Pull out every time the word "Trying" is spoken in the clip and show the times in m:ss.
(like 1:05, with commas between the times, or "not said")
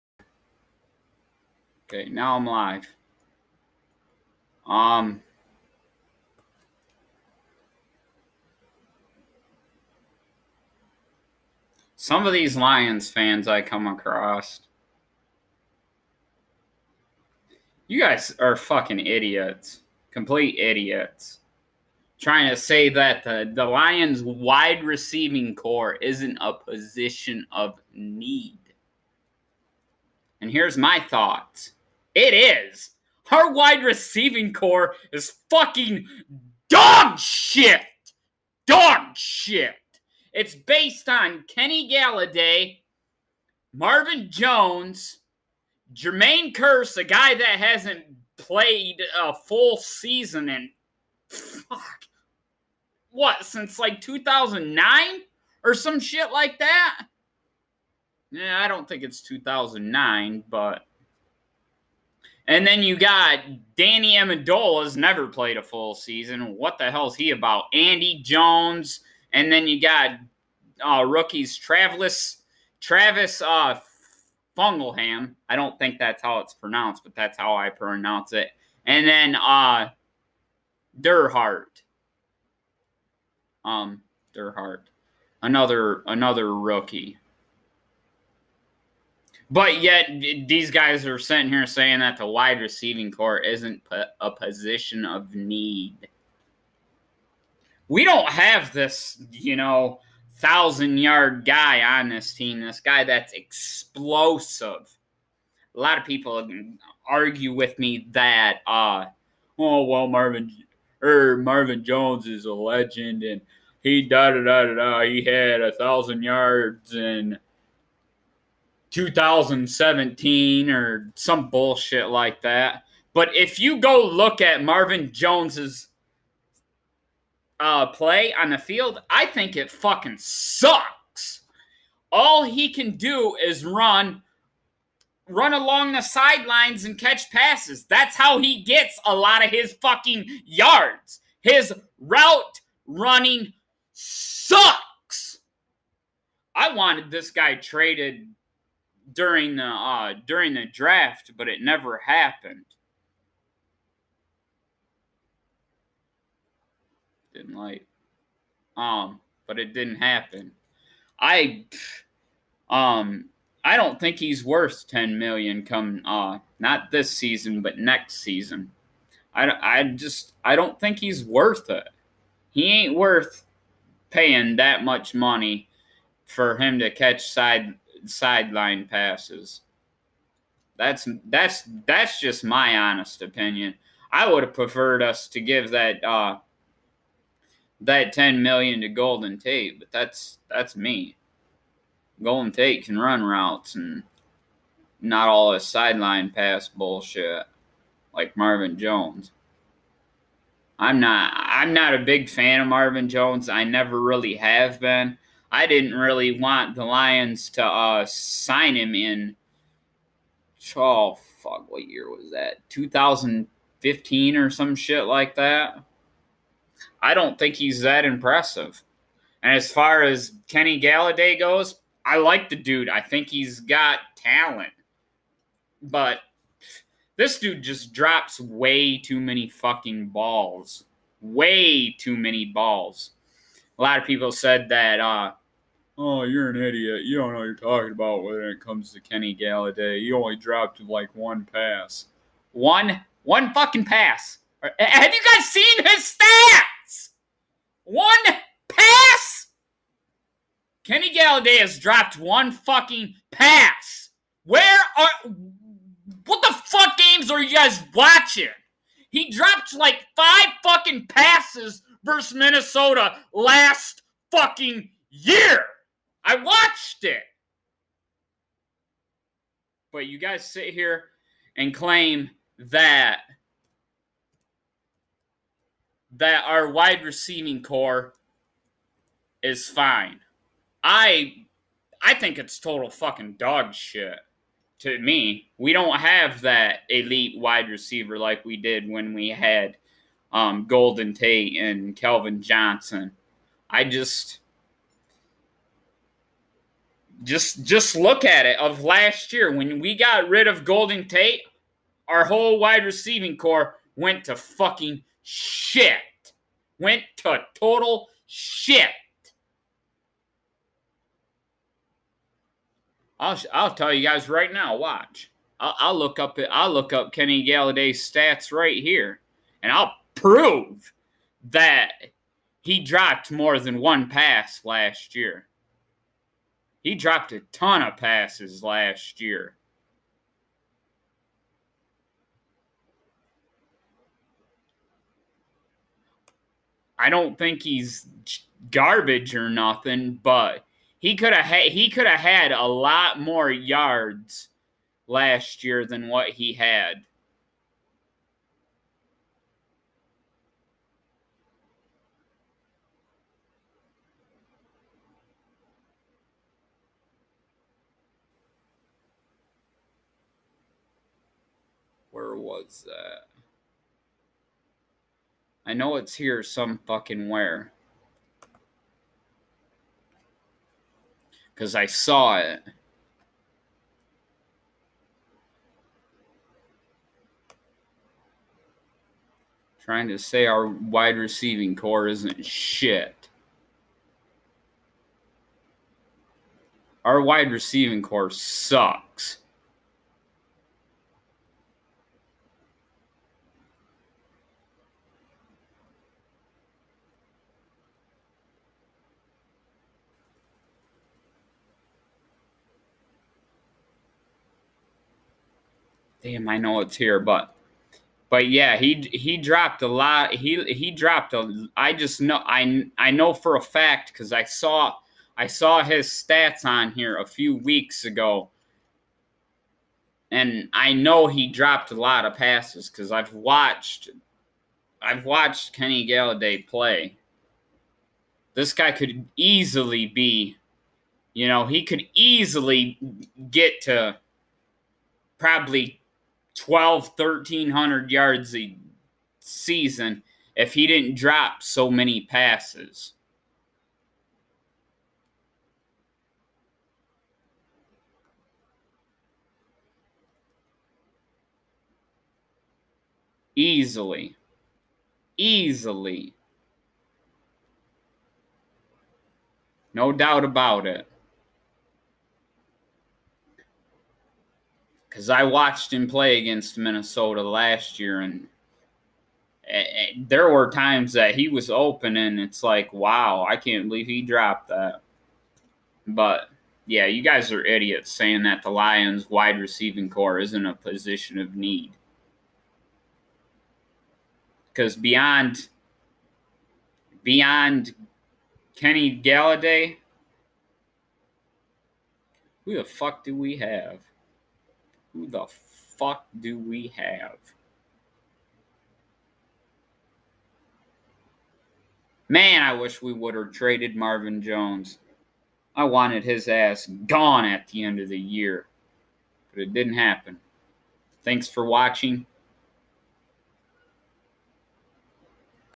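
0:22, 6:19.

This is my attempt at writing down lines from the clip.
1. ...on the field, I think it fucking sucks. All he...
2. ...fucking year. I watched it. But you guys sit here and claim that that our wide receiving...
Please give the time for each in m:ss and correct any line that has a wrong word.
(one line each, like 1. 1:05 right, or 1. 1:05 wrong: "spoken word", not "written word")
1. 2:08 right
2. 4:24 right.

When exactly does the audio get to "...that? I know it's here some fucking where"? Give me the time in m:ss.
6:02.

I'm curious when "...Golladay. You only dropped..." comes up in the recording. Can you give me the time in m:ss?
3:59.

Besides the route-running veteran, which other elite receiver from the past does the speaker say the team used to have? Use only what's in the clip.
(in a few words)
Calvin Johnson.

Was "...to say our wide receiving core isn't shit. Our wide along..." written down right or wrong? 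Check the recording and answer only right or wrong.
wrong.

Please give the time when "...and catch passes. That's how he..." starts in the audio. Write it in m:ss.
2:16.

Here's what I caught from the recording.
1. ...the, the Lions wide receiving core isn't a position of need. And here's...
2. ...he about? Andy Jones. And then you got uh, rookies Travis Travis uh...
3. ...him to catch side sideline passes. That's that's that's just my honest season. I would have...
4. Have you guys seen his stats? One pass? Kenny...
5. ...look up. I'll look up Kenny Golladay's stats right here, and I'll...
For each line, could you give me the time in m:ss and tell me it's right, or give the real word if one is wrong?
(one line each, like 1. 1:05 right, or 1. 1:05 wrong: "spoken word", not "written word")
1. 0:23 right
2. 1:07 right
3. 2:56 wrong: "opinion", not "season"
4. 4:04 right
5. 5:15 right.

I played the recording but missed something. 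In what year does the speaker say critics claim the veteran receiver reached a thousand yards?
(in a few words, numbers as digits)
2017.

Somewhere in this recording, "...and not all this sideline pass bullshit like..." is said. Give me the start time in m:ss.
3:13.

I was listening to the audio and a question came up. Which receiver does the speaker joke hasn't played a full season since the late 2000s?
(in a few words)
Jermaine Kearse.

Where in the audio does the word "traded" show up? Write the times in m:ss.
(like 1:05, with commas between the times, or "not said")
2:27, 8:23.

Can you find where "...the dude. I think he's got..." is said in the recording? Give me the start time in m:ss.
3:42.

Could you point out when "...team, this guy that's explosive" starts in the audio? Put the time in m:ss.
1:42.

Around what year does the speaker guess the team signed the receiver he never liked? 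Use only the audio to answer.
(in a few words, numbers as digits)
2015.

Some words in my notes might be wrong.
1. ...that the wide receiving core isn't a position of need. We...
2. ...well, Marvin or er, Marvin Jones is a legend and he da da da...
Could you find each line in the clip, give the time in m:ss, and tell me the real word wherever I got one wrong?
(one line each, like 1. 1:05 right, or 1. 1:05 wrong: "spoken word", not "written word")
1. 1:31 right
2. 1:49 right.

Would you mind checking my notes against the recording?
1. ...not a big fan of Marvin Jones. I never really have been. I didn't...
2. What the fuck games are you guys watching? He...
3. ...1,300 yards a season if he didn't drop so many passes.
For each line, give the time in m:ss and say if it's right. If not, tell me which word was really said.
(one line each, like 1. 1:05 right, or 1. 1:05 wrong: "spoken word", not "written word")
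1. 3:21 right
2. 4:16 right
3. 7:17 right.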